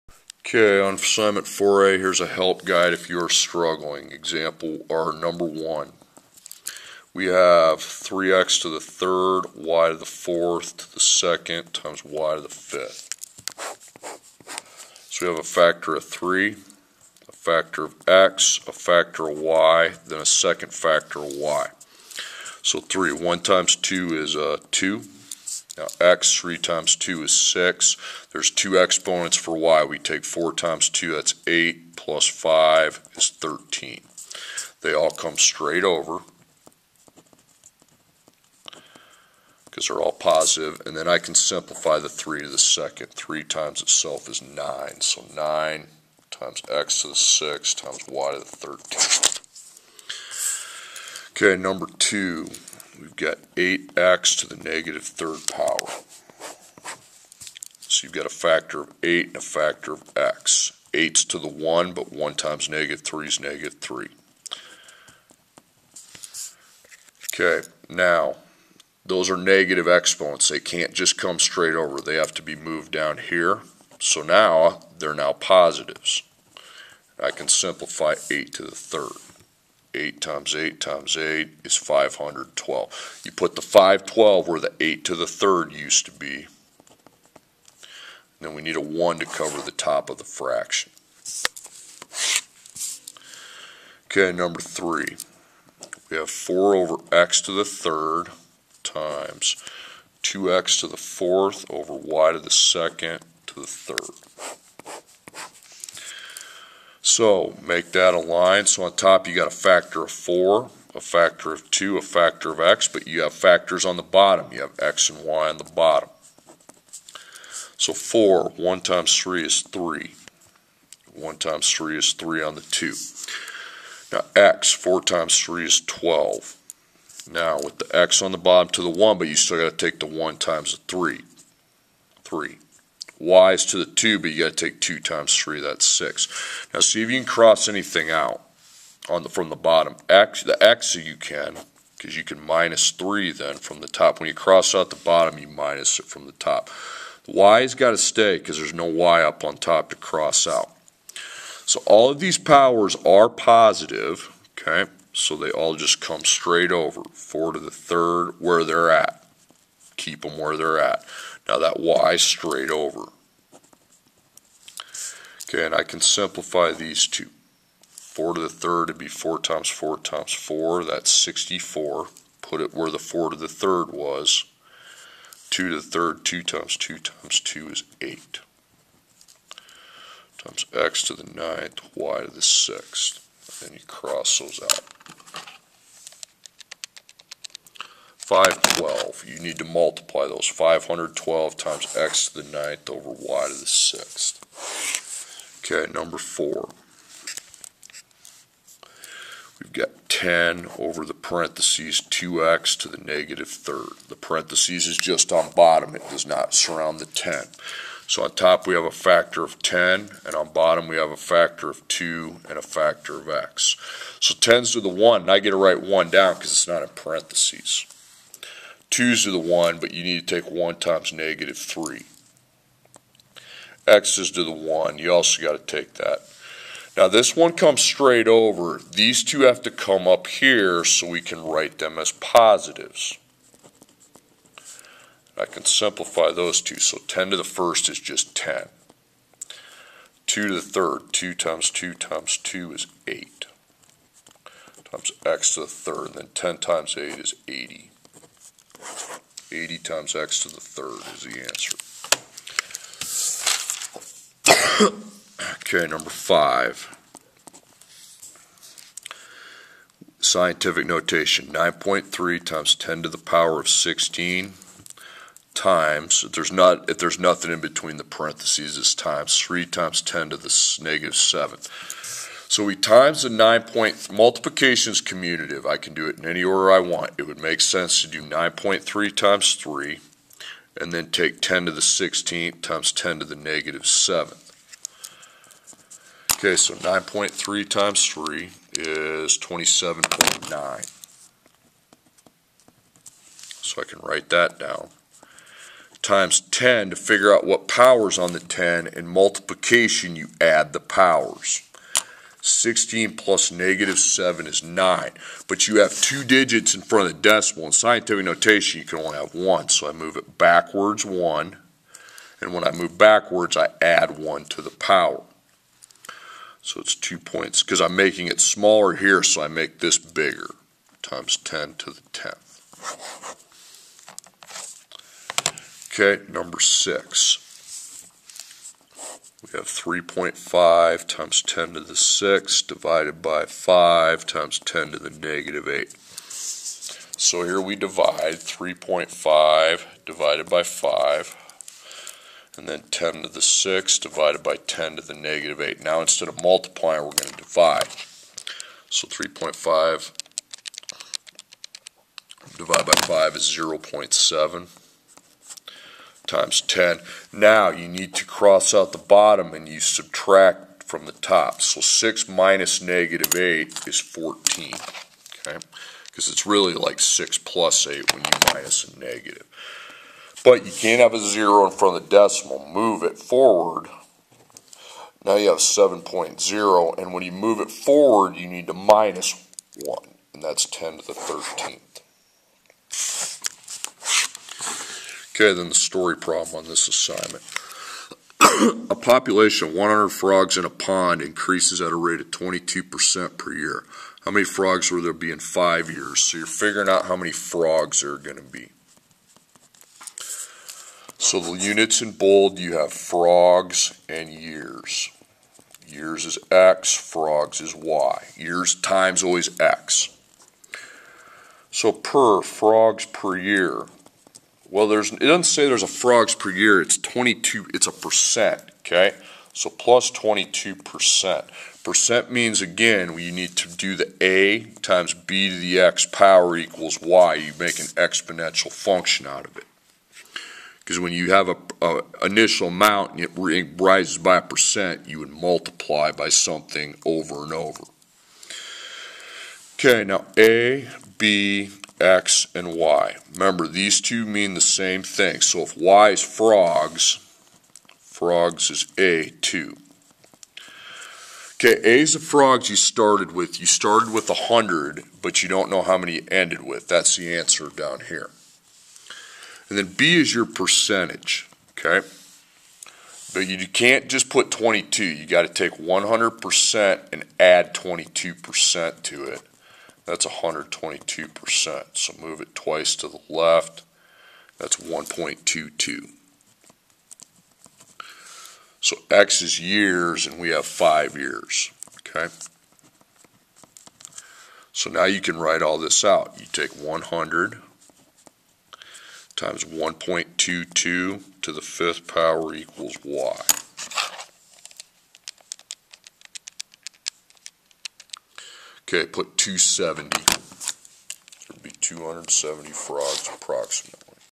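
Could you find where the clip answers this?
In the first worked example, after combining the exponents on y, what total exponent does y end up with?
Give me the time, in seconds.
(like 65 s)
31 s.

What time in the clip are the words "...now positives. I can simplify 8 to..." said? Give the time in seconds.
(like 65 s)
75 s.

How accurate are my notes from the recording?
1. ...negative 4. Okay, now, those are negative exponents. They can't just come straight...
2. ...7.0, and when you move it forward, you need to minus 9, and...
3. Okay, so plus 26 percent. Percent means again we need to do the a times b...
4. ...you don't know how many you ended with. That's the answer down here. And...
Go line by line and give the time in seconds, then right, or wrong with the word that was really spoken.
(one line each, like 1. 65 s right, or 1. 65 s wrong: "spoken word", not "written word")
1. 63 s wrong: "3", not "4"
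2. 375 s wrong: "1", not "9"
3. 418 s wrong: "22", not "26"
4. 455 s right.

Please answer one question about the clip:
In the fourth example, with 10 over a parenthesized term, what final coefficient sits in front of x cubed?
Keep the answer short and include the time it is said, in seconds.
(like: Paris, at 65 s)
80, at 246 s.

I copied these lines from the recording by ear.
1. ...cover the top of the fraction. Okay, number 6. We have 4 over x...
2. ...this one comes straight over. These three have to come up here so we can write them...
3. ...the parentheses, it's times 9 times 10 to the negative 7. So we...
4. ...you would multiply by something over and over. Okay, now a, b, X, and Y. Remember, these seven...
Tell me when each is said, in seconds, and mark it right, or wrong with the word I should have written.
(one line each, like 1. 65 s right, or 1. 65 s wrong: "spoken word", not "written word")
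1. 89 s wrong: "3", not "6"
2. 227 s wrong: "two", not "three"
3. 267 s wrong: "3", not "9"
4. 435 s wrong: "two", not "seven".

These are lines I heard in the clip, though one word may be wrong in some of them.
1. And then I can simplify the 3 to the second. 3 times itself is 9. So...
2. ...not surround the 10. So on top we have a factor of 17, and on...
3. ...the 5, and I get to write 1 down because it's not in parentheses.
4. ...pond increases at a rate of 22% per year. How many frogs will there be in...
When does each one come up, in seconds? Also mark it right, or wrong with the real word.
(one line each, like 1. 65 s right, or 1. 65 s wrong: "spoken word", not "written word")
1. 40 s right
2. 206 s wrong: "10", not "17"
3. 214 s wrong: "1", not "5"
4. 390 s right.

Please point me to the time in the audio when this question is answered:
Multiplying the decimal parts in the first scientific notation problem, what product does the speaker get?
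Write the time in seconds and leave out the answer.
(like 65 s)
289 s.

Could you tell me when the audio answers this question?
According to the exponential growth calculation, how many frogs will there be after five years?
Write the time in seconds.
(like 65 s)
501 s.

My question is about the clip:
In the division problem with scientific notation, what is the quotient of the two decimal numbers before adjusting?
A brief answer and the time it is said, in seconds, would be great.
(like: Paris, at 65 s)
0.7, at 353 s.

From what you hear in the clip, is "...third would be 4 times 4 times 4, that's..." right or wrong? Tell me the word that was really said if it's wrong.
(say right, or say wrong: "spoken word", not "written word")
right.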